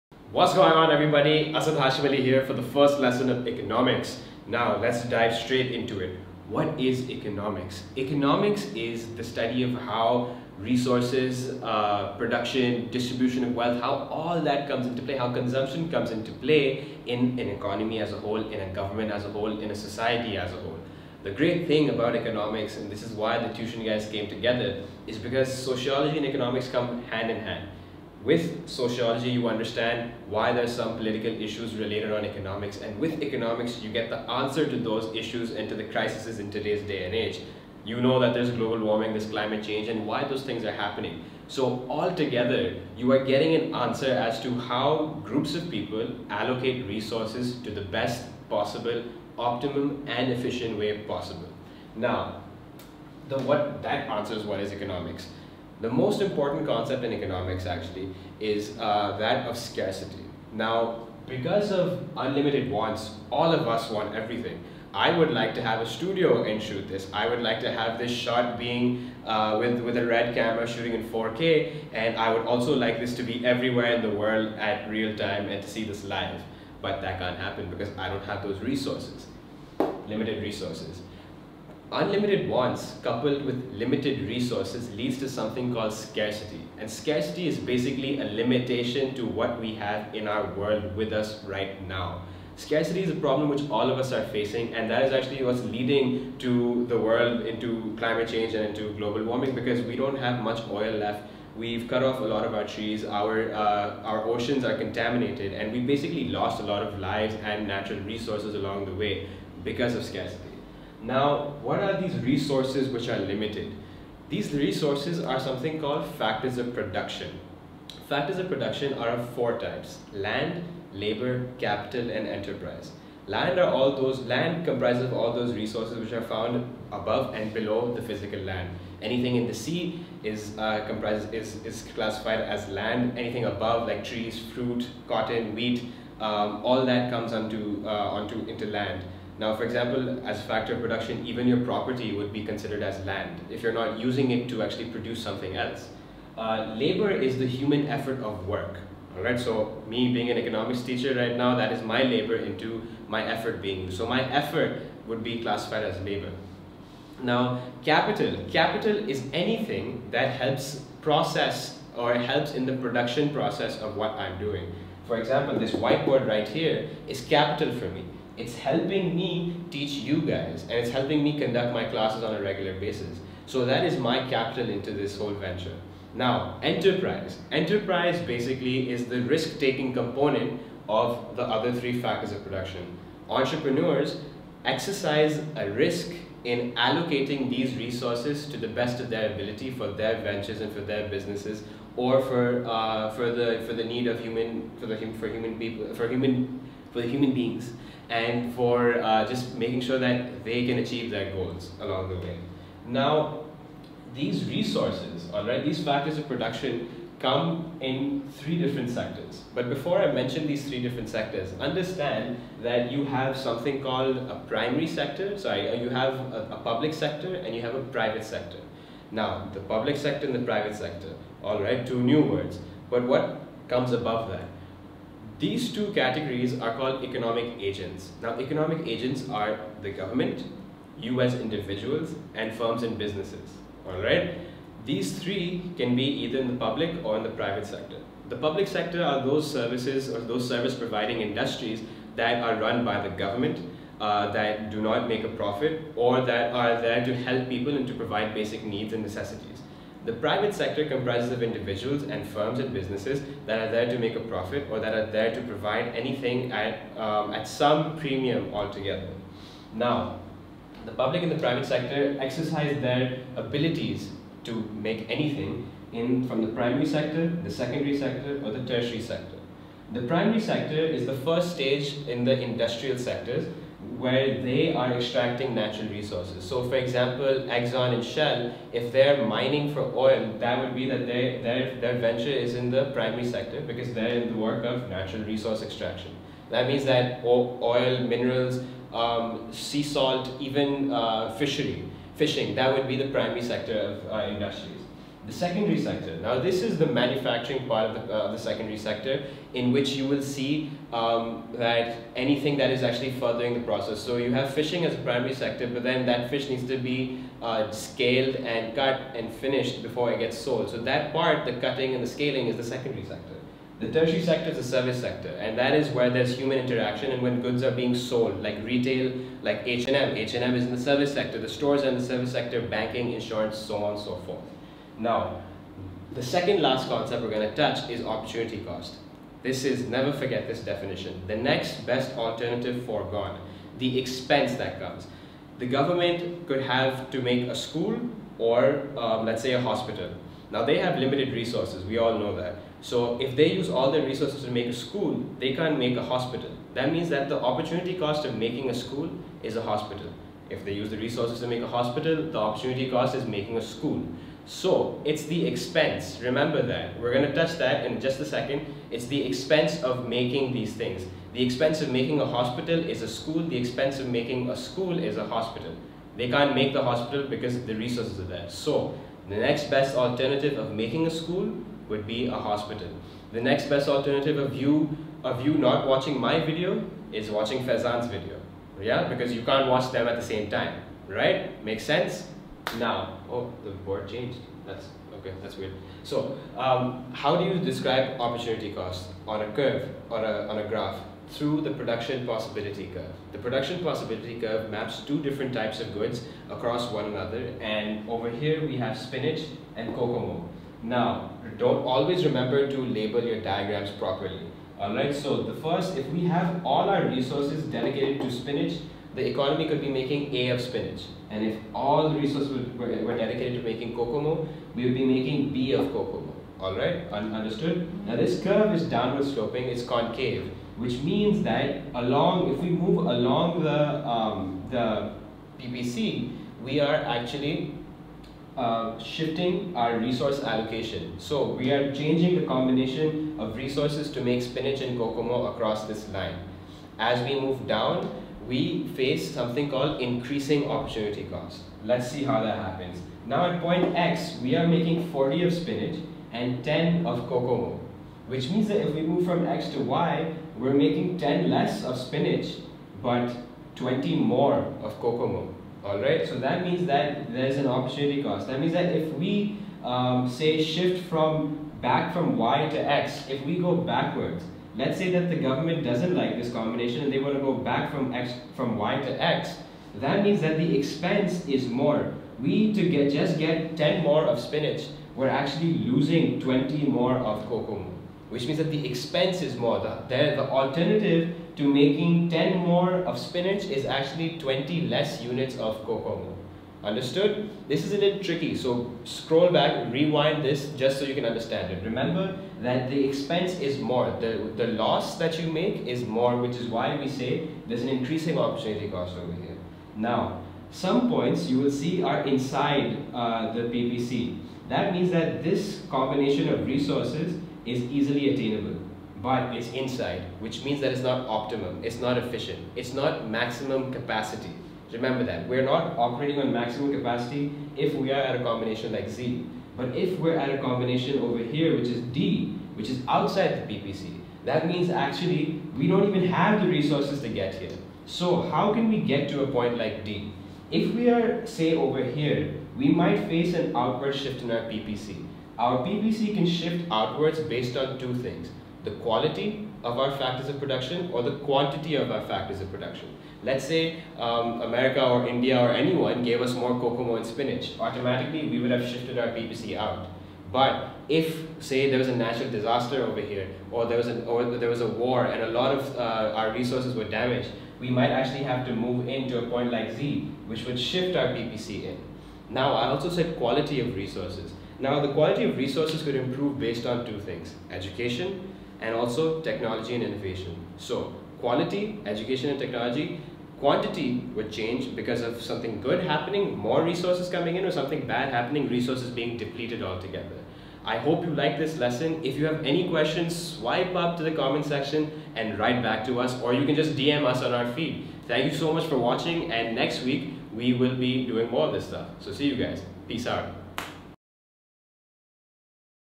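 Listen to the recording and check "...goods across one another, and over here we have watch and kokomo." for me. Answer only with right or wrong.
wrong.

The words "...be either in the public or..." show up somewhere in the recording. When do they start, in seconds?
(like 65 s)
235 s.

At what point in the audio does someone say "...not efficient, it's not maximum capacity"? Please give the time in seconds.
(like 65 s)
511 s.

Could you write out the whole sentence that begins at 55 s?
The most important concept in economics actually is uh, that of scarcity.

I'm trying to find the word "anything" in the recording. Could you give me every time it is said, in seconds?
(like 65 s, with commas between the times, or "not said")
129 s, 133 s, 159 s, 255 s, 265 s, 302 s.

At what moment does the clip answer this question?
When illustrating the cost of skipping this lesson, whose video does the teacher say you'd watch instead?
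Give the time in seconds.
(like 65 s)
377 s.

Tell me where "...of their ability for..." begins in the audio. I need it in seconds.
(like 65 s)
188 s.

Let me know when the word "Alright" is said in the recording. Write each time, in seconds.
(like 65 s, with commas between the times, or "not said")
233 s, 404 s.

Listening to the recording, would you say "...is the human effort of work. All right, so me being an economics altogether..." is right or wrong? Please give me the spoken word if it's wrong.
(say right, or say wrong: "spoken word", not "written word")
wrong: "teacher", not "altogether".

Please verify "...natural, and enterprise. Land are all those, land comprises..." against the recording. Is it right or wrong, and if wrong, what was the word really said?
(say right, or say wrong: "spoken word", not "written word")
wrong: "capital", not "natural".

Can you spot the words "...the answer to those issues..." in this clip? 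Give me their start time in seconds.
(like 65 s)
34 s.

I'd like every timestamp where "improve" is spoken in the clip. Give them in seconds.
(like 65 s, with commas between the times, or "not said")
566 s.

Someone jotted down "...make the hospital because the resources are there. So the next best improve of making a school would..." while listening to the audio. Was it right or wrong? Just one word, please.
wrong.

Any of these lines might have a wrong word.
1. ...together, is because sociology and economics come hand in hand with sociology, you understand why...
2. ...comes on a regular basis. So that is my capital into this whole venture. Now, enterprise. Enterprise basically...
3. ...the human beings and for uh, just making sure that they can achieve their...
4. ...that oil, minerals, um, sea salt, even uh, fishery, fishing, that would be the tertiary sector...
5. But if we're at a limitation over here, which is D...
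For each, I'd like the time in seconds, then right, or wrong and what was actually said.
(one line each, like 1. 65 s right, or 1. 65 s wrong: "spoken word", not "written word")
1. 24 s right
2. 171 s wrong: "classes", not "comes"
3. 197 s right
4. 286 s wrong: "primary", not "tertiary"
5. 519 s wrong: "combination", not "limitation".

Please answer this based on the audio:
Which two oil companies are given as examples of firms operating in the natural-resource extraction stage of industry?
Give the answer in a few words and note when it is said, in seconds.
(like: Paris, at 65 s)
Exxon and Shell, at 277 s.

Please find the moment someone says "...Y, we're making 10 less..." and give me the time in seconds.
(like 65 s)
449 s.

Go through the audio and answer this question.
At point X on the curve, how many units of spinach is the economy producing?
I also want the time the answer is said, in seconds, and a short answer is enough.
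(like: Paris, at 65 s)
40, at 445 s.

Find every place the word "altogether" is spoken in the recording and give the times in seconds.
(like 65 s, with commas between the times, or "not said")
41 s, 258 s, 579 s.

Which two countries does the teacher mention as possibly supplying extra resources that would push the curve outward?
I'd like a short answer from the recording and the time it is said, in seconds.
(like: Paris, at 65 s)
America or India, at 544 s.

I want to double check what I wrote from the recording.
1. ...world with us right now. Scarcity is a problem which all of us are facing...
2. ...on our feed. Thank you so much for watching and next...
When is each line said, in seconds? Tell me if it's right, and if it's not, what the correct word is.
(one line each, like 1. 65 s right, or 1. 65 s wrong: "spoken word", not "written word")
1. 90 s right
2. 587 s right.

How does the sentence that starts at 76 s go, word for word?
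But that can't happen because I don't have those resources, limited resources.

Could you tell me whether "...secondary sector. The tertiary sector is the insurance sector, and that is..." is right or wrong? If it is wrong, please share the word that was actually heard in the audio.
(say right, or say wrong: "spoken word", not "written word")
wrong: "service", not "insurance".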